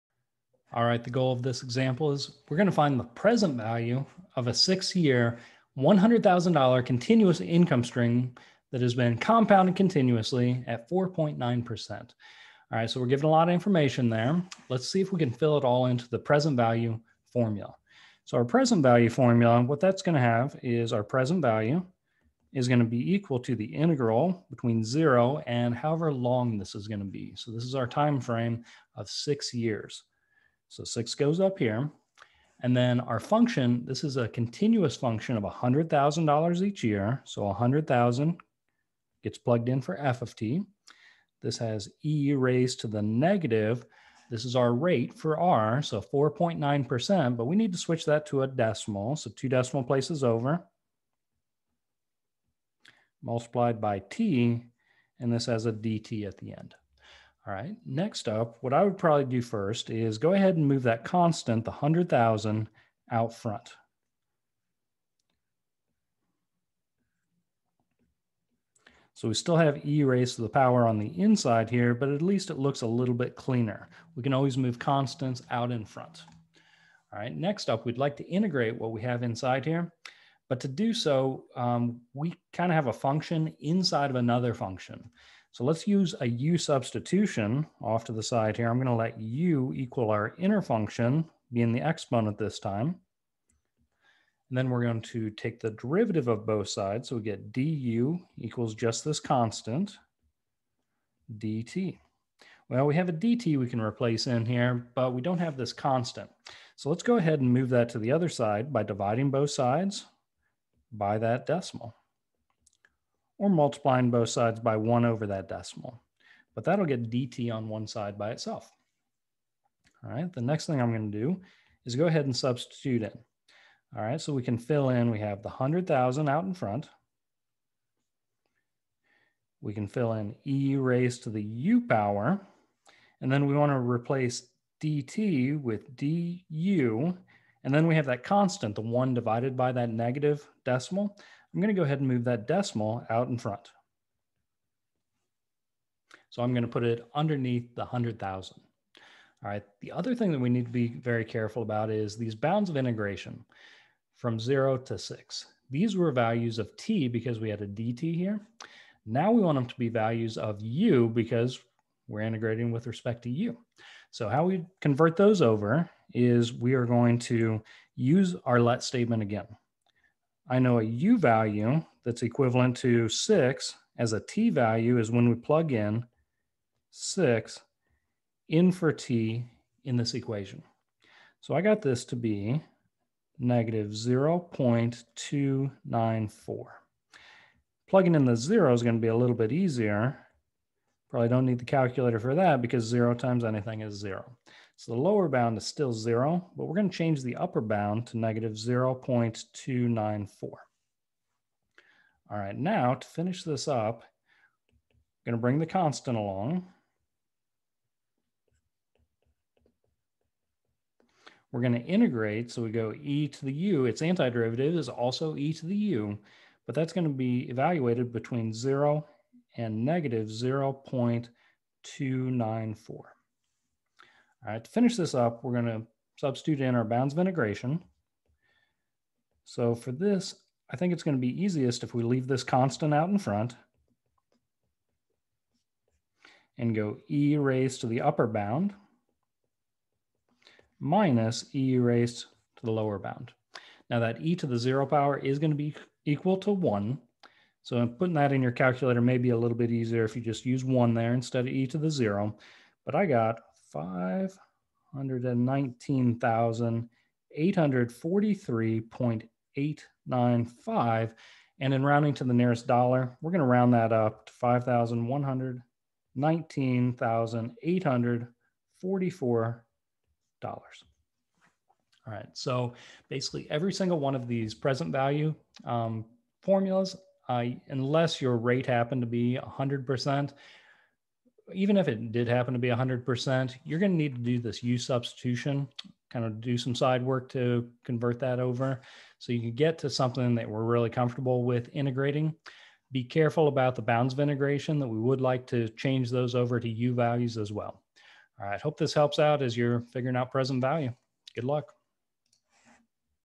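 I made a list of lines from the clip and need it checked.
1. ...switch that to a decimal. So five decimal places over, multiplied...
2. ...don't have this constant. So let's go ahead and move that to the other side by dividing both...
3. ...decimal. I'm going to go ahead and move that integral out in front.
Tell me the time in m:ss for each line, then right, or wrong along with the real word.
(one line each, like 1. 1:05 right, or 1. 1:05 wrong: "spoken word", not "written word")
1. 0:47 wrong: "two", not "five"
2. 1:45 right
3. 2:20 wrong: "decimal", not "integral".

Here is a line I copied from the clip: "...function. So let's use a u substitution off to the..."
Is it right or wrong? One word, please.
right.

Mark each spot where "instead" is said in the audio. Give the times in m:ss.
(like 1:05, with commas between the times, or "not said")
4:11.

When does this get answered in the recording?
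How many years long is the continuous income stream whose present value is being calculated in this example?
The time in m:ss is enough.
0:04.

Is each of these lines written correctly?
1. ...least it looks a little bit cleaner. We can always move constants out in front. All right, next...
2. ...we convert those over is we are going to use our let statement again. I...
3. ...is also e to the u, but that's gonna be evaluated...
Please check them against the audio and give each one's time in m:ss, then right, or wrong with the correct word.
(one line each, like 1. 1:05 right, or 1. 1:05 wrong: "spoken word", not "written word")
1. 1:12 right
2. 2:44 right
3. 3:34 right.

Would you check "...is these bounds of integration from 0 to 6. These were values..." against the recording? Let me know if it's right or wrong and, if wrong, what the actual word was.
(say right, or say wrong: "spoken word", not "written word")
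right.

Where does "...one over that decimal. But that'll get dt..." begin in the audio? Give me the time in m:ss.
1:54.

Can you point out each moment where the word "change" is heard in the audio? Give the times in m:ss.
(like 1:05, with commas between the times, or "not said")
3:16, 4:55.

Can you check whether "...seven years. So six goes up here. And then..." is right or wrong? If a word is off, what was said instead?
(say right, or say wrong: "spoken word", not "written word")
wrong: "six", not "seven".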